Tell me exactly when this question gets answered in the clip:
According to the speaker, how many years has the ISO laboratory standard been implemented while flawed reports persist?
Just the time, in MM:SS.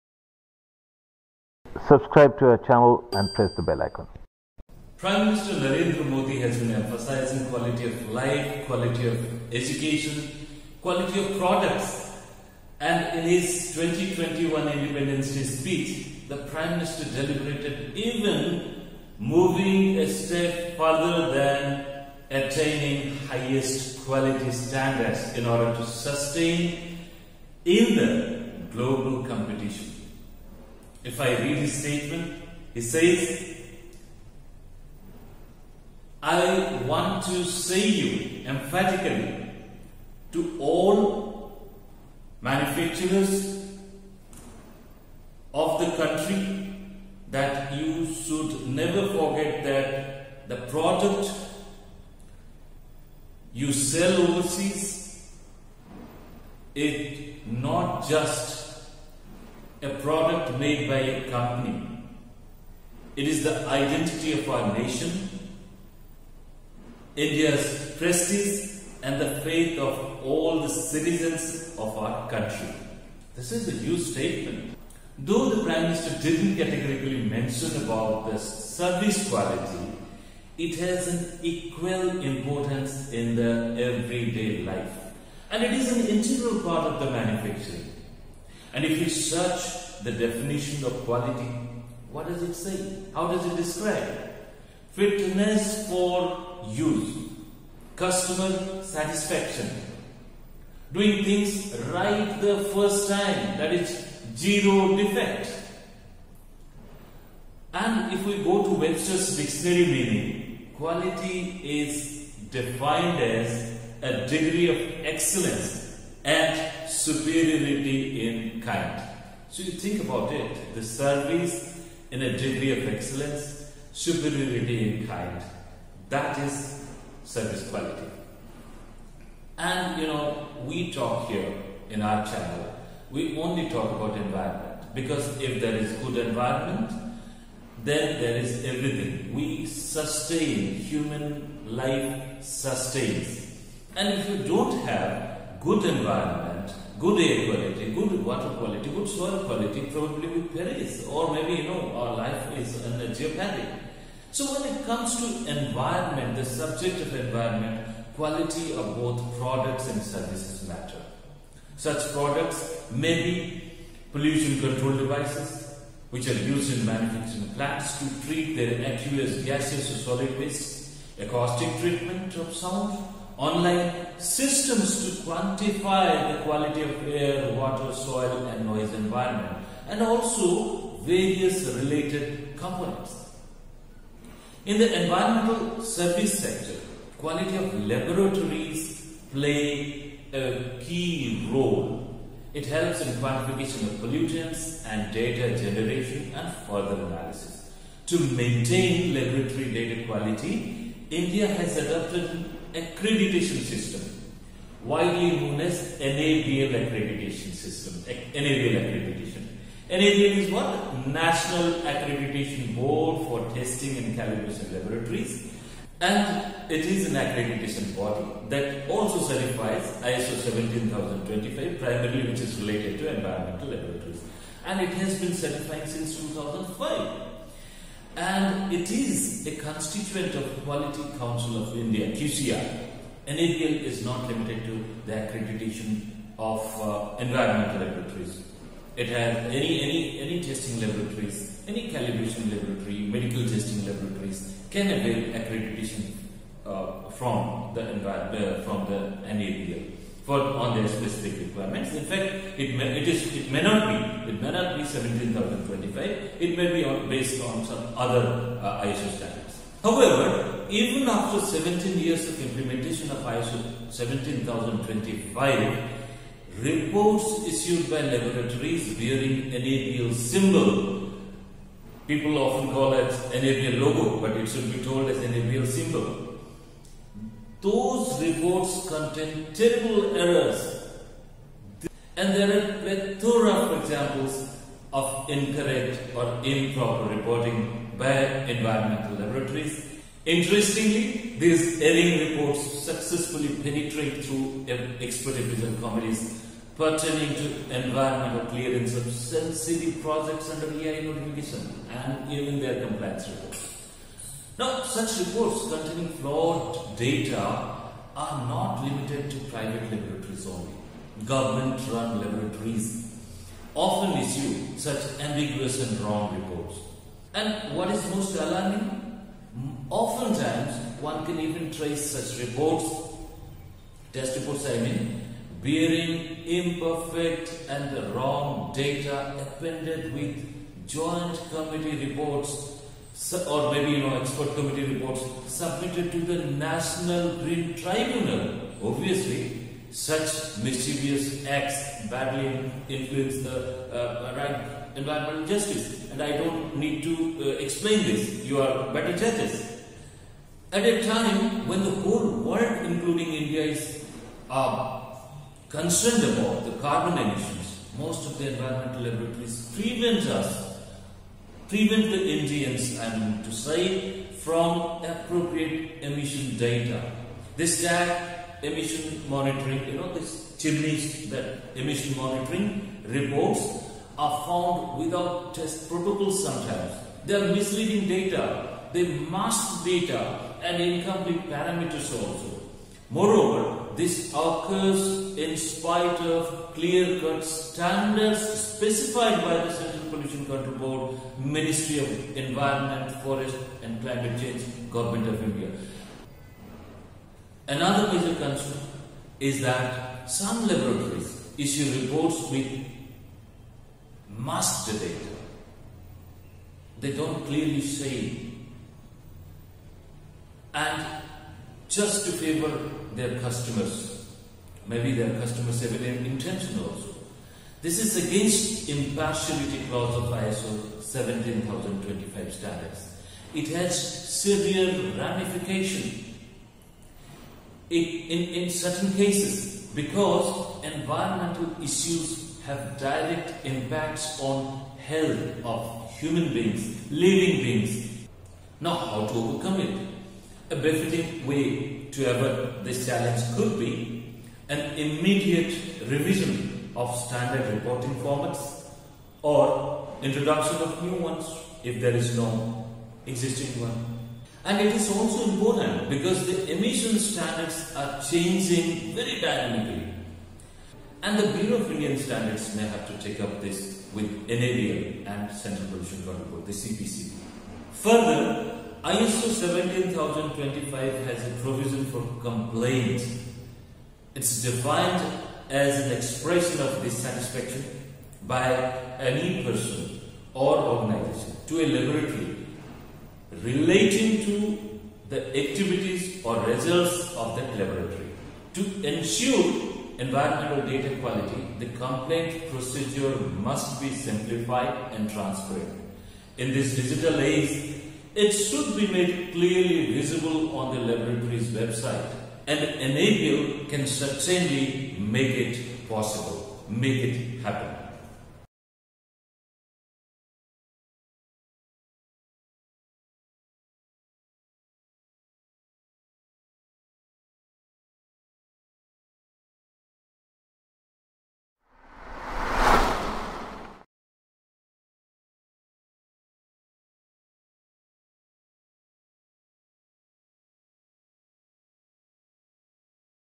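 04:21.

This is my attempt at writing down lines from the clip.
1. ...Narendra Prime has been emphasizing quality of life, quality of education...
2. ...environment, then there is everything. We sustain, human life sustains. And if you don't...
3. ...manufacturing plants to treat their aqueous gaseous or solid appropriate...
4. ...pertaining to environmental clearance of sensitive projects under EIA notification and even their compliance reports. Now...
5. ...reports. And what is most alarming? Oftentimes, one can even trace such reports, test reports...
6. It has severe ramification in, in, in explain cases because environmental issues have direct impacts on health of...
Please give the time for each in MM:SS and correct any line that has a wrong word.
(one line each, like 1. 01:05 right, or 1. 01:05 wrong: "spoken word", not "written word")
1. 00:05 wrong: "Modi", not "Prime"
2. 02:16 right
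3. 02:46 wrong: "waste", not "appropriate"
4. 04:56 right
5. 05:16 right
6. 07:03 wrong: "certain", not "explain".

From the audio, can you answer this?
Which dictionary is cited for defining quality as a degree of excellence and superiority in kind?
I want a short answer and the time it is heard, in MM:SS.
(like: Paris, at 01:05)
Webster's dictionary, at 01:48.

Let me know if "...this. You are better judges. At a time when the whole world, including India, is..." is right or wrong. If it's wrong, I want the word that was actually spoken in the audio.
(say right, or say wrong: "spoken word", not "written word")
right.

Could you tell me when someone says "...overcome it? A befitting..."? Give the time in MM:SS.
07:19.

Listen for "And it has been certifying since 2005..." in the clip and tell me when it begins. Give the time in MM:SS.
03:44.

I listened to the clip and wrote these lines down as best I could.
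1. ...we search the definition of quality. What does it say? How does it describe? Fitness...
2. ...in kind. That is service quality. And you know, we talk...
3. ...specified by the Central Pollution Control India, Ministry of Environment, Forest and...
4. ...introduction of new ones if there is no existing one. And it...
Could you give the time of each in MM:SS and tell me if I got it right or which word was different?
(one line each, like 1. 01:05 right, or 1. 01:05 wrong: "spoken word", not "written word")
1. 01:28 right
2. 02:05 right
3. 06:28 wrong: "Board", not "India"
4. 07:30 right.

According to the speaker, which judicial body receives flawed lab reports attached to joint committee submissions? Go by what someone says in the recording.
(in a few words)
National Green Tribunal.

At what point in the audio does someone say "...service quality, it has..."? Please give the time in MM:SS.
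01:18.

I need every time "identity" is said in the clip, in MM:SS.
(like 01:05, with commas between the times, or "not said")
01:03.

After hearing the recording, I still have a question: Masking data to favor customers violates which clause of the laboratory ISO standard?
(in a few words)
Impartiality clause.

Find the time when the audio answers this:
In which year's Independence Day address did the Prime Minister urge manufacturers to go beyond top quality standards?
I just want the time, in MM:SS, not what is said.
00:13.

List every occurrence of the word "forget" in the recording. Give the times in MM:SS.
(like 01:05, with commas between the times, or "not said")
00:49.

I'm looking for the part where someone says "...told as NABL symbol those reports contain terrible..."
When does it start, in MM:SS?
04:34.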